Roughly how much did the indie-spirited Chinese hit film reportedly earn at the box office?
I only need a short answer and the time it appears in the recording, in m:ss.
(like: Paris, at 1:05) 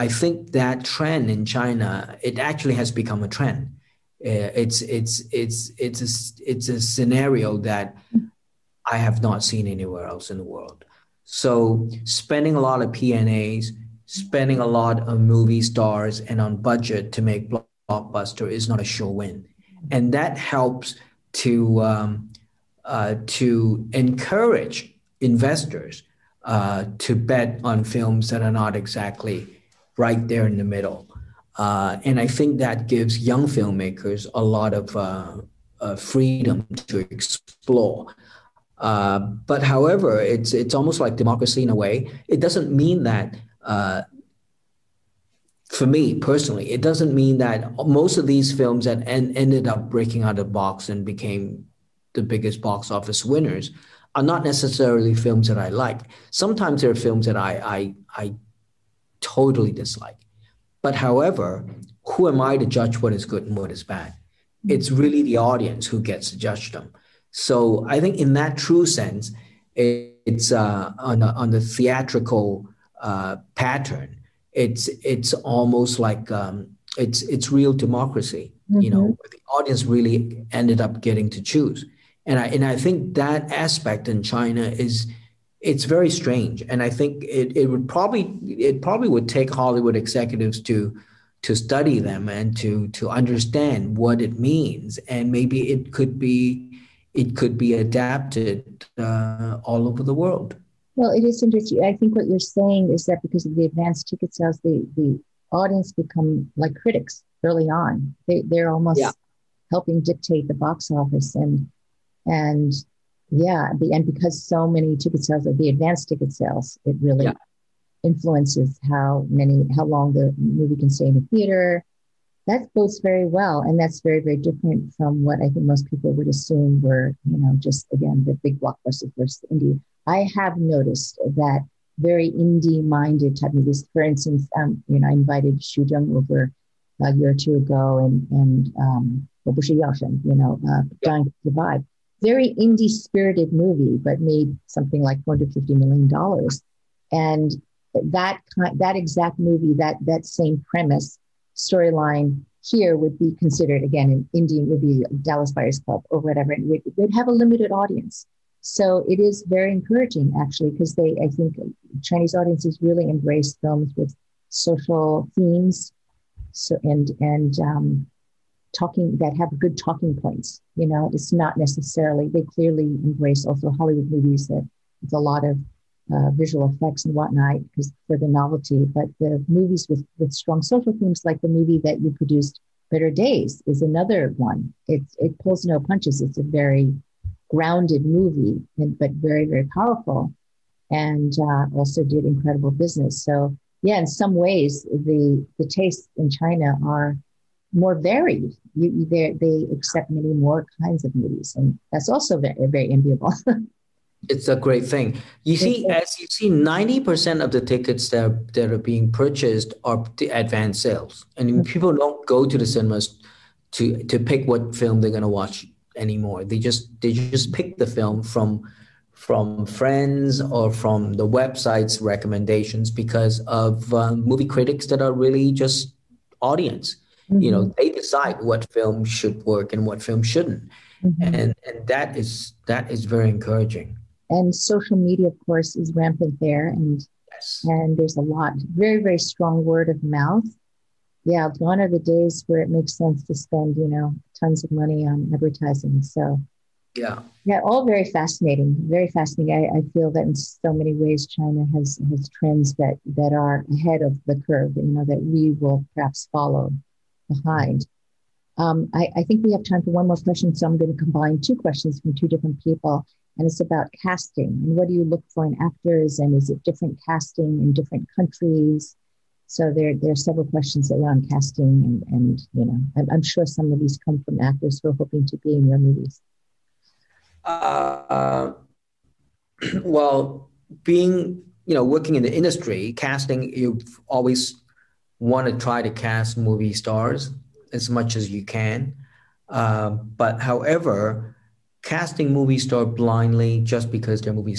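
$450 million, at 2:25.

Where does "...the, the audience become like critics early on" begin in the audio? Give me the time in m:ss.
1:44.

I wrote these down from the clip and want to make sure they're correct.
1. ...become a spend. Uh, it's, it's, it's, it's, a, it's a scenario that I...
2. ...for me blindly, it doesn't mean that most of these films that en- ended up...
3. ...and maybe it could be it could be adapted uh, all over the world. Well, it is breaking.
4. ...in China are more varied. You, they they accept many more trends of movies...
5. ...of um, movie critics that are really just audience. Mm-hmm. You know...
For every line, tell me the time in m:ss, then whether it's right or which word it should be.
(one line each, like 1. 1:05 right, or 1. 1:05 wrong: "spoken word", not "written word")
1. 0:02 wrong: "trend", not "spend"
2. 0:45 wrong: "personally", not "blindly"
3. 1:35 wrong: "interesting", not "breaking"
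4. 3:16 wrong: "kinds", not "trends"
5. 3:43 right.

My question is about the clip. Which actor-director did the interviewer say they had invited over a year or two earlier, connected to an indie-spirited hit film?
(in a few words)
Xu Zheng.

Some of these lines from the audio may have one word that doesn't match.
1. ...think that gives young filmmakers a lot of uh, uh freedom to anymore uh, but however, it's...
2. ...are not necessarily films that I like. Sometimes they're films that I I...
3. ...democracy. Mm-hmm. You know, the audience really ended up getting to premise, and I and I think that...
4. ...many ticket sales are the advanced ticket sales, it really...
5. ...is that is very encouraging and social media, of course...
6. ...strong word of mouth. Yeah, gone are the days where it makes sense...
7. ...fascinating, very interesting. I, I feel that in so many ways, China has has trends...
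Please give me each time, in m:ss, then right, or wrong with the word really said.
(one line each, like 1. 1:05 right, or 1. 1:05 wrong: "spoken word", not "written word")
1. 0:32 wrong: "explore", not "anymore"
2. 0:54 right
3. 1:17 wrong: "choose", not "premise"
4. 1:54 right
5. 3:52 right
6. 3:59 right
7. 4:08 wrong: "fascinating", not "interesting".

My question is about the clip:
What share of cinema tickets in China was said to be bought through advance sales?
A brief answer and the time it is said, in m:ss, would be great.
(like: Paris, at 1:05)
90%, at 3:26.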